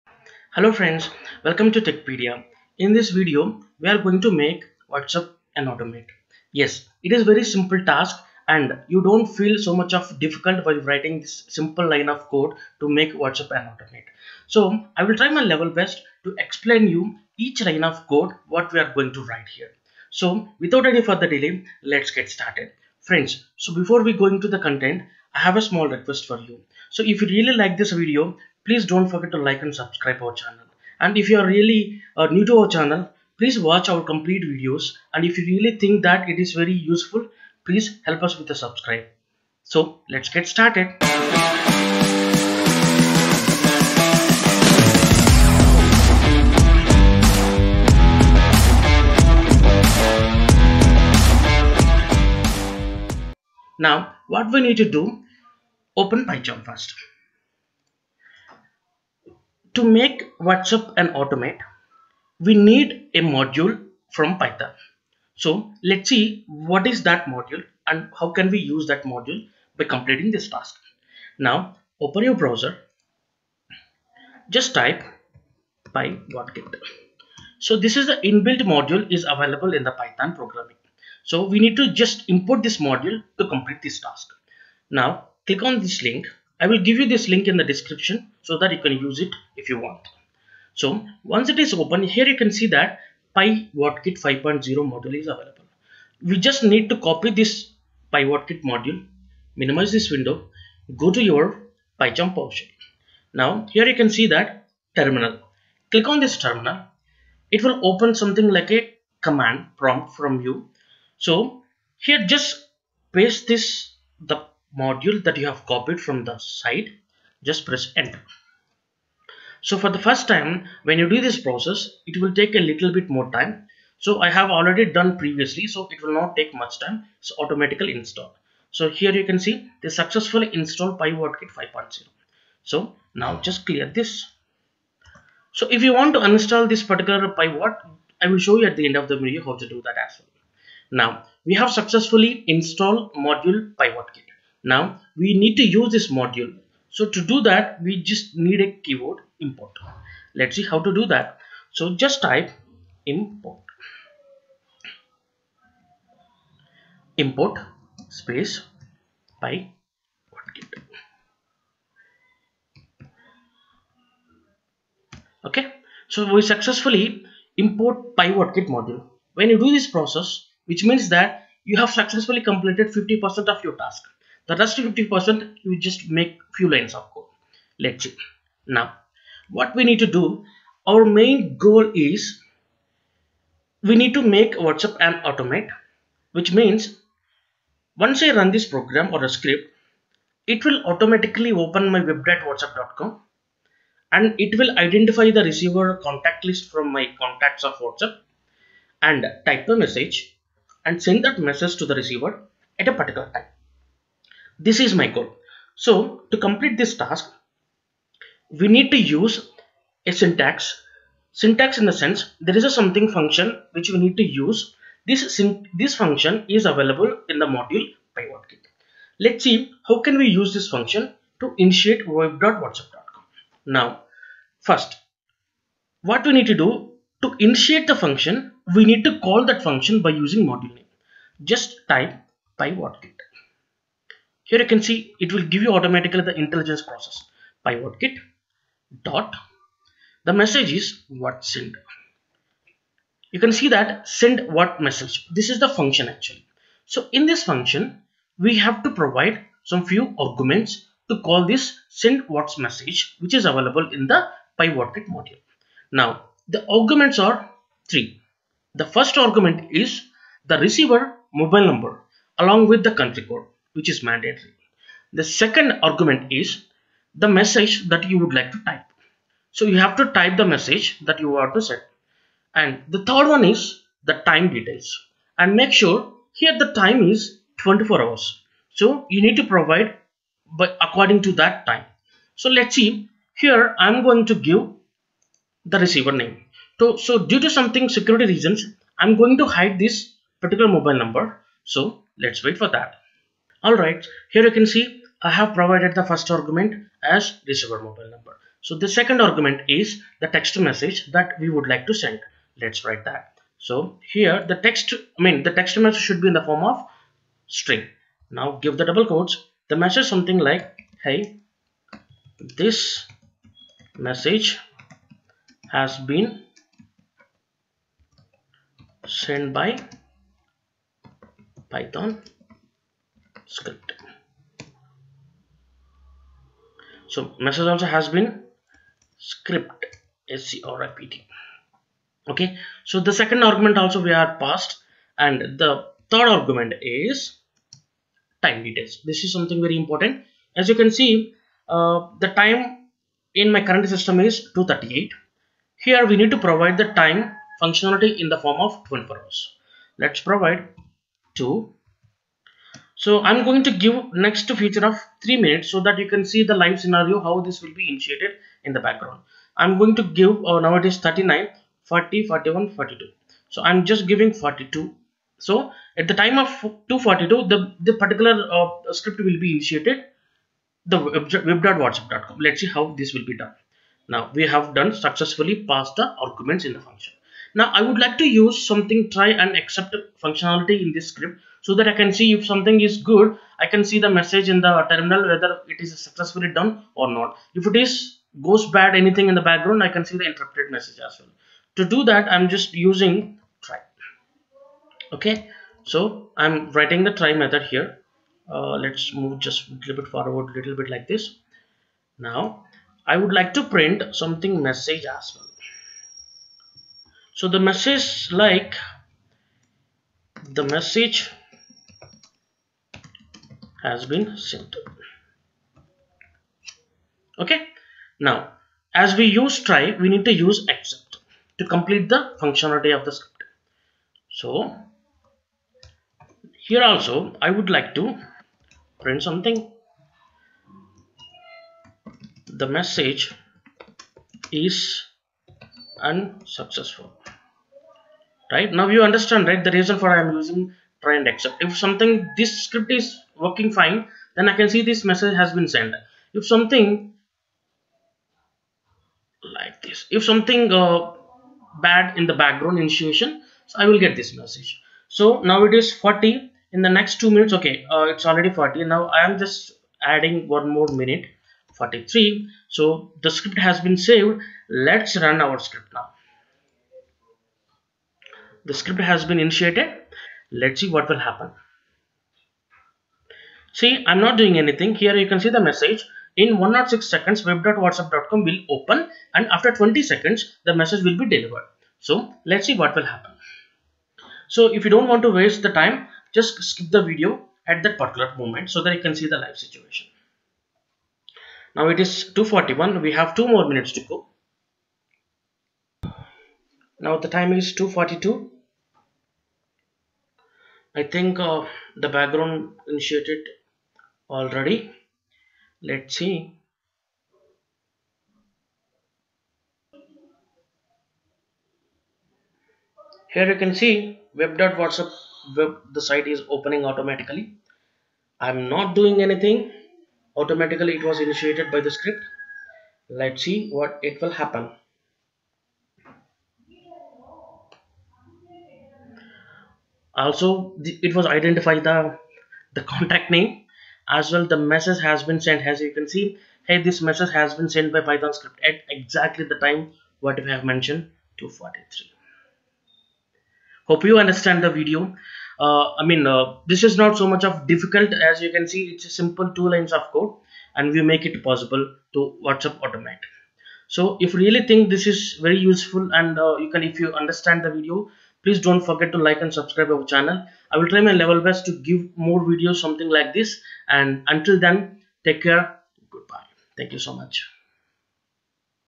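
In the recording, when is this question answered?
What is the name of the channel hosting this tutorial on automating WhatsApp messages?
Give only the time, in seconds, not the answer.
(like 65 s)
1 s.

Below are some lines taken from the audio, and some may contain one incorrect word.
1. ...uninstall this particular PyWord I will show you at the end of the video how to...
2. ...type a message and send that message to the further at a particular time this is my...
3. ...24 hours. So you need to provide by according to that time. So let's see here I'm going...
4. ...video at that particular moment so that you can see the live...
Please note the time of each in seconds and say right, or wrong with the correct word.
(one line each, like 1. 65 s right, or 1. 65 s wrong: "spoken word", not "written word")
1. 136 s right
2. 199 s wrong: "receiver", not "further"
3. 277 s right
4. 487 s right.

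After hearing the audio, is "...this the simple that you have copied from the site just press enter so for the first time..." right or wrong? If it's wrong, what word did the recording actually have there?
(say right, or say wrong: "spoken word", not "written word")
wrong: "module", not "simple".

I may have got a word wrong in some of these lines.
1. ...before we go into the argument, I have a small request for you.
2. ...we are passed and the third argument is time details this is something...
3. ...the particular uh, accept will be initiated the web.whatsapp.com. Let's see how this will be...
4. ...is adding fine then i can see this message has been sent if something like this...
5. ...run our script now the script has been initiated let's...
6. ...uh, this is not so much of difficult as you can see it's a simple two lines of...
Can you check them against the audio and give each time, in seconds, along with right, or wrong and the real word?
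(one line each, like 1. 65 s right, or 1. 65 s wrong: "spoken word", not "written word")
1. 23 s wrong: "content", not "argument"
2. 334 s right
3. 367 s wrong: "script", not "accept"
4. 442 s wrong: "working", not "adding"
5. 465 s right
6. 546 s right.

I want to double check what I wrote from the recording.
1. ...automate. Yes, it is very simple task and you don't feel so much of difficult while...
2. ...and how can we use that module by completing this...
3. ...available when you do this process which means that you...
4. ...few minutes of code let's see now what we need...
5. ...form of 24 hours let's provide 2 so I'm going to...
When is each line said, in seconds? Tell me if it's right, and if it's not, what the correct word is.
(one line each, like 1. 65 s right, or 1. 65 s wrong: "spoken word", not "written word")
1. 5 s right
2. 67 s right
3. 168 s wrong: "module", not "available"
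4. 176 s wrong: "lines", not "minutes"
5. 348 s right.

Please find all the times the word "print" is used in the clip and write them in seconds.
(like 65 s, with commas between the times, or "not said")
403 s, 429 s.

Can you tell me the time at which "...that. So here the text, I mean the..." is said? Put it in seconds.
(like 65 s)
303 s.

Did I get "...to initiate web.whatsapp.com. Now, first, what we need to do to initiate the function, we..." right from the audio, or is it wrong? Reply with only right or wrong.
right.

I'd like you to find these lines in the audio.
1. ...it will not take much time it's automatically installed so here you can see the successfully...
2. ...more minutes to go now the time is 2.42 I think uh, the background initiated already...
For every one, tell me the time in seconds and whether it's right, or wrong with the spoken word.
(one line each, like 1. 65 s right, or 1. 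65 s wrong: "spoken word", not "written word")
1. 125 s right
2. 493 s right.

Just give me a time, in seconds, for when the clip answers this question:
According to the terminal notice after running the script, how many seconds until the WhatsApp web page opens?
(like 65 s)
476 s.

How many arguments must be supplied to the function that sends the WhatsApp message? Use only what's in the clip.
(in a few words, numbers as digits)
3.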